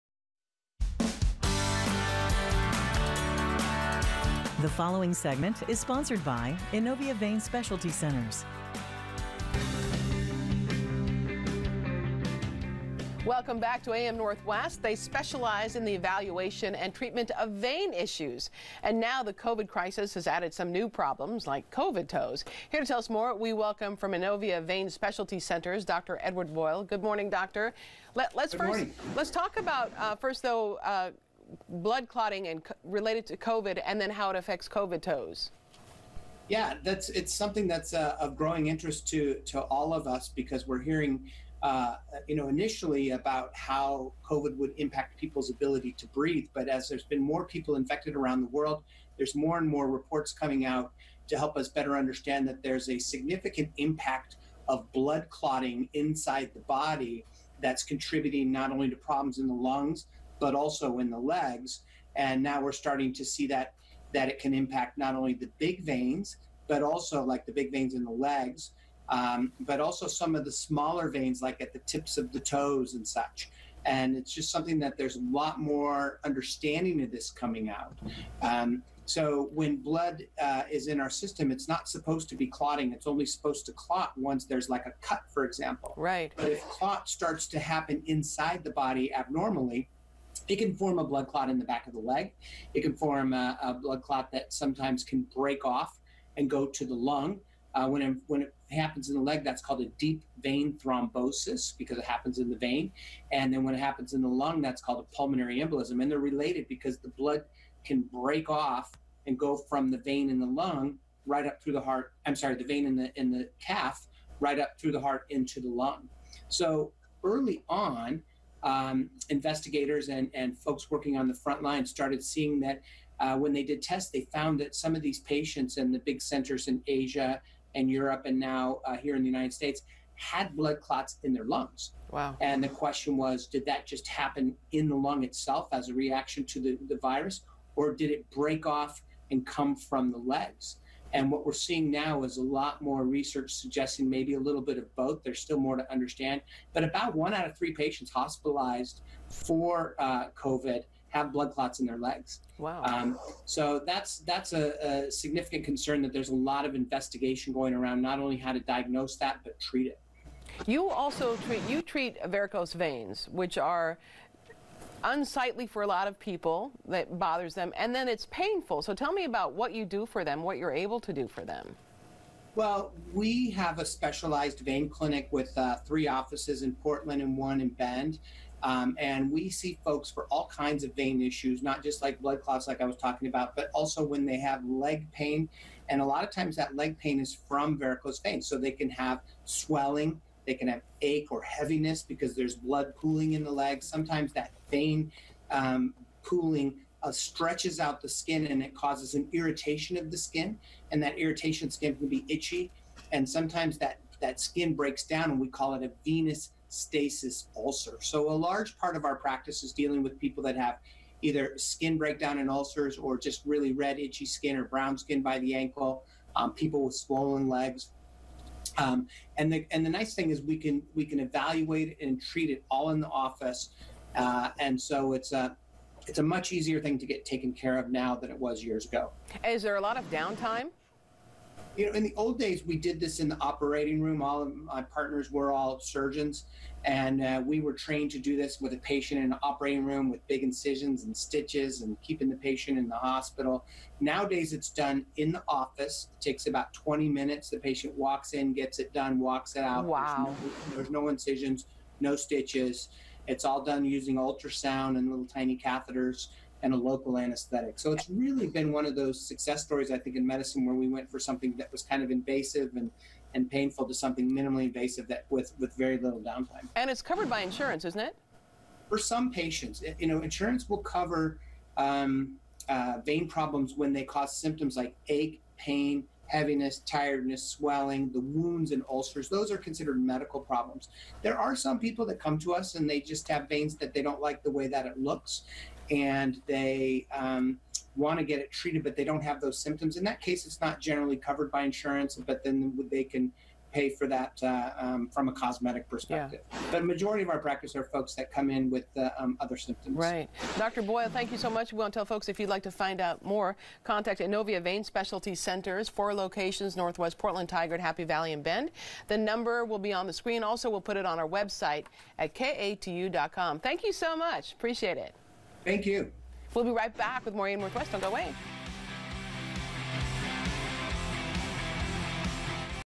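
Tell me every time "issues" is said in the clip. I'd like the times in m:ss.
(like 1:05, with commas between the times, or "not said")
0:17, 3:01.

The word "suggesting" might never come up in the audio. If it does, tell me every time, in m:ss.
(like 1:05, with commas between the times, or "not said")
2:23.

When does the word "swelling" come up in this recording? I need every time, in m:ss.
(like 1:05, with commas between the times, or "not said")
3:09, 4:37.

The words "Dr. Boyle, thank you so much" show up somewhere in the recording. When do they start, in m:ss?
5:00.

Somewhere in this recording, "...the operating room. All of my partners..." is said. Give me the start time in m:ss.
3:53.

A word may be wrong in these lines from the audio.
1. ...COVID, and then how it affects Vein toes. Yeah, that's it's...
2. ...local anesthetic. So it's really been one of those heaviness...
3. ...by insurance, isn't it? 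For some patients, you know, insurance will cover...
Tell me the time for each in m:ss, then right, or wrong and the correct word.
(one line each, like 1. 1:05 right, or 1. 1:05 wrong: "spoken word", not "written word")
1. 0:33 wrong: "COVID", not "Vein"
2. 4:16 wrong: "success", not "heaviness"
3. 4:27 right.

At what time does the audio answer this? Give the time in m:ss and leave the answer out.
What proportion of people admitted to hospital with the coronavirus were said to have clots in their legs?
2:27.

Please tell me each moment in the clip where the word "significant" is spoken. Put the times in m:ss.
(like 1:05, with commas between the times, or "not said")
0:52, 2:35.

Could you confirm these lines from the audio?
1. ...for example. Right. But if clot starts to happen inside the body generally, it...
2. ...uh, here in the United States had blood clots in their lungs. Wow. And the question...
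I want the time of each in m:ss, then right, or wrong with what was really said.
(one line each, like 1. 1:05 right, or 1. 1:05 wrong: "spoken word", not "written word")
1. 1:25 wrong: "abnormally", not "generally"
2. 2:08 right.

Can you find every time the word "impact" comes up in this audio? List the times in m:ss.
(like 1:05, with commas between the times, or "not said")
0:44, 0:53, 1:04.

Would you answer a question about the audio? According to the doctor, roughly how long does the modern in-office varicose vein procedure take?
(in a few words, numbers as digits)
20 minutes.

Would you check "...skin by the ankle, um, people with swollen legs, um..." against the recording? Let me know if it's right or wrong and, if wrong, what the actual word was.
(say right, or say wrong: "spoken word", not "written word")
right.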